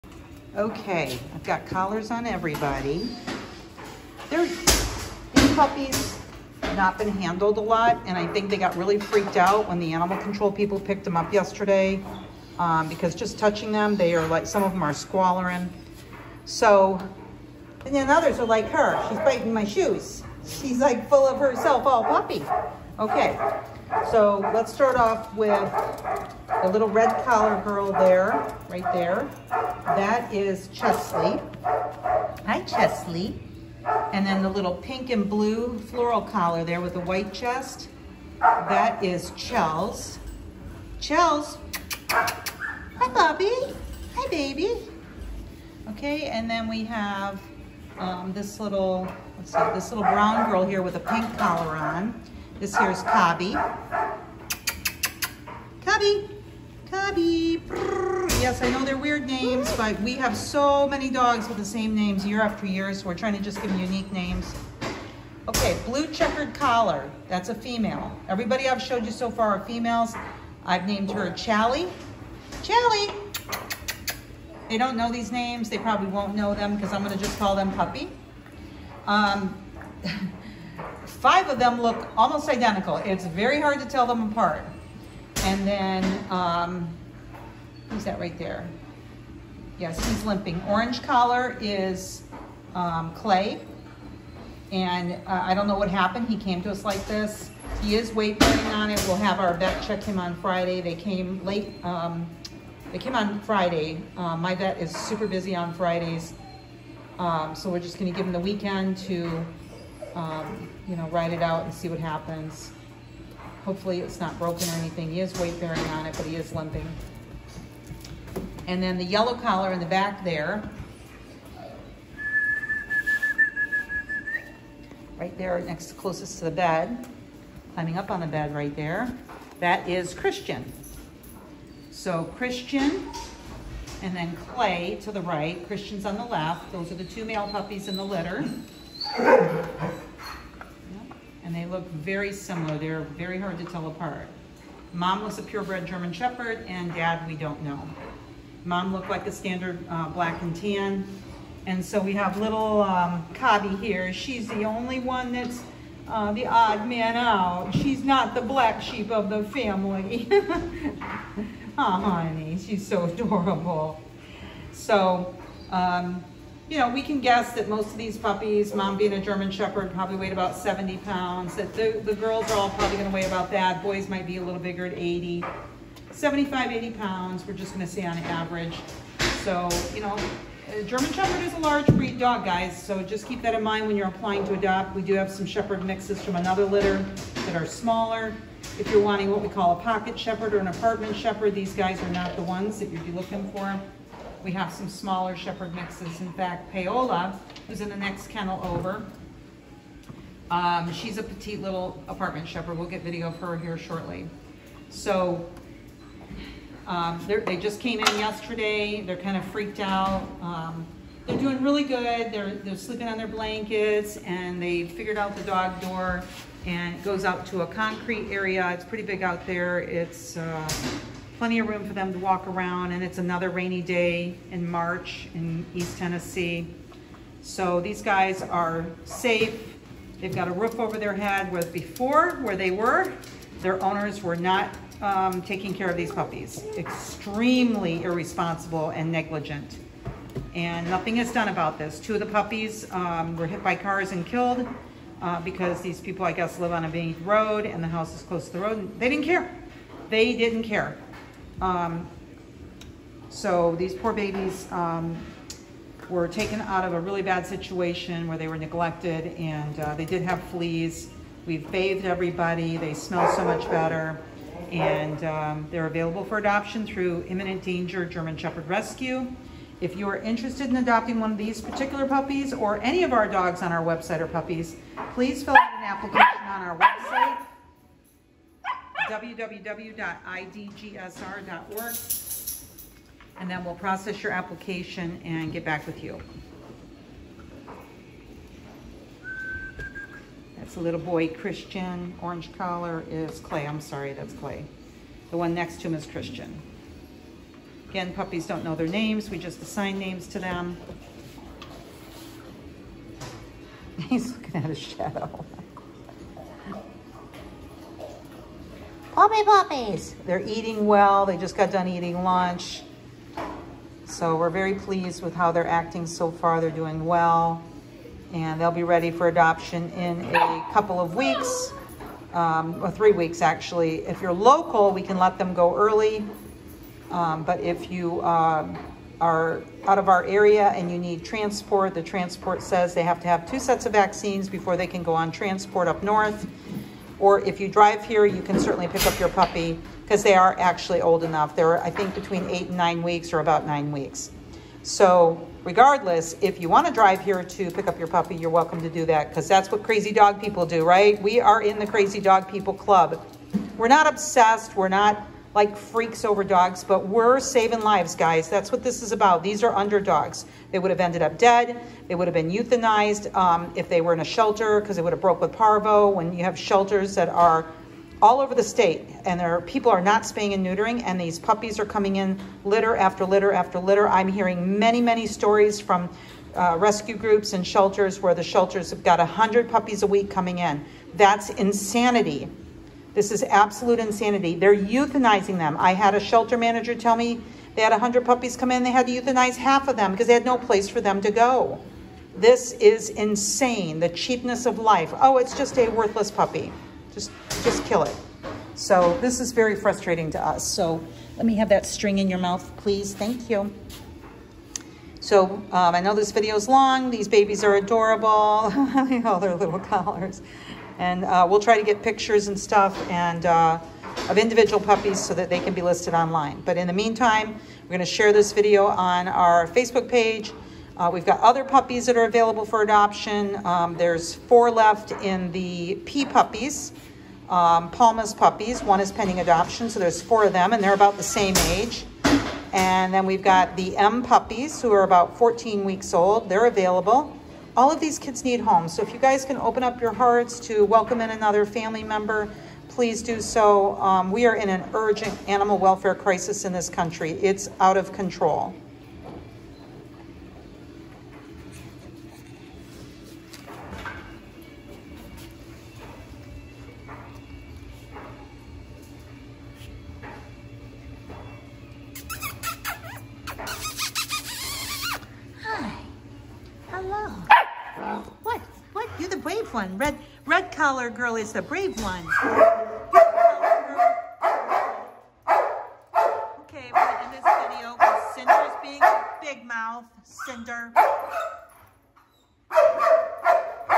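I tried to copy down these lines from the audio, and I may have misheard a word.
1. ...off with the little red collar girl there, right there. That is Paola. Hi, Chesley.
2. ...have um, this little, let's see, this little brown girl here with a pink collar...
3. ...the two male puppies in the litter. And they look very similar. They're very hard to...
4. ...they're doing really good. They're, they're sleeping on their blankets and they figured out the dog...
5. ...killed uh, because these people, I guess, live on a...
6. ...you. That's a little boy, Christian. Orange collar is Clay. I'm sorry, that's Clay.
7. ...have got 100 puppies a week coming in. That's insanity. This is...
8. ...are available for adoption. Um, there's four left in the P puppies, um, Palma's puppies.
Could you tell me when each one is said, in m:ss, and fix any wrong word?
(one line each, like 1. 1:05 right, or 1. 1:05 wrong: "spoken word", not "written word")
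1. 0:24 wrong: "Chesley", not "Paola"
2. 0:46 right
3. 2:16 right
4. 3:31 right
5. 4:04 right
6. 4:46 right
7. 6:18 right
8. 7:02 right.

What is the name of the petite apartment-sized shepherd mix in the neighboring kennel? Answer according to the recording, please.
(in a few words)
Paola.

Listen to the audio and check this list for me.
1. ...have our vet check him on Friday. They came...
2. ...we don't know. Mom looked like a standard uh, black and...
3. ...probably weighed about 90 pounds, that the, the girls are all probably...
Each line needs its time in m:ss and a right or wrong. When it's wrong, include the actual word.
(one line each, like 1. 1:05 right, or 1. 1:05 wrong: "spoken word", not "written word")
1. 1:39 right
2. 2:27 right
3. 2:49 wrong: "70", not "90".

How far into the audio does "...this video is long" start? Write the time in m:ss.
6:46.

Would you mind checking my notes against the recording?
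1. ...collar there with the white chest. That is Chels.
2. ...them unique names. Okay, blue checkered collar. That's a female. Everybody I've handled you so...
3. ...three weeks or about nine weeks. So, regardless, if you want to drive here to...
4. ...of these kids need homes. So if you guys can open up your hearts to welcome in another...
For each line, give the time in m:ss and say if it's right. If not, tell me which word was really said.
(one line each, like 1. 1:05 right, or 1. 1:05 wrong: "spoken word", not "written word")
1. 0:36 right
2. 1:03 wrong: "showed", not "handled"
3. 5:42 wrong: "nine", not "three"
4. 7:17 right.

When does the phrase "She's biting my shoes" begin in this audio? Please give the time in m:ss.
0:19.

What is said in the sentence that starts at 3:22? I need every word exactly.
We'll get video of her here shortly.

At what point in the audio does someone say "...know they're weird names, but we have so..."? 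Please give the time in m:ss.
0:58.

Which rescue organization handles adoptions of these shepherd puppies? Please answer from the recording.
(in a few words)
Imminent Danger German Shepherd Rescue.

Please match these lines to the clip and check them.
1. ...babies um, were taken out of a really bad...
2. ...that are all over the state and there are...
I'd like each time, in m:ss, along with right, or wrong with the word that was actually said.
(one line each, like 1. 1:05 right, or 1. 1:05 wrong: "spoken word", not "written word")
1. 4:14 right
2. 6:07 right.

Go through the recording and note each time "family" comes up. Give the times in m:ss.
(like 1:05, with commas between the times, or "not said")
2:39, 7:21.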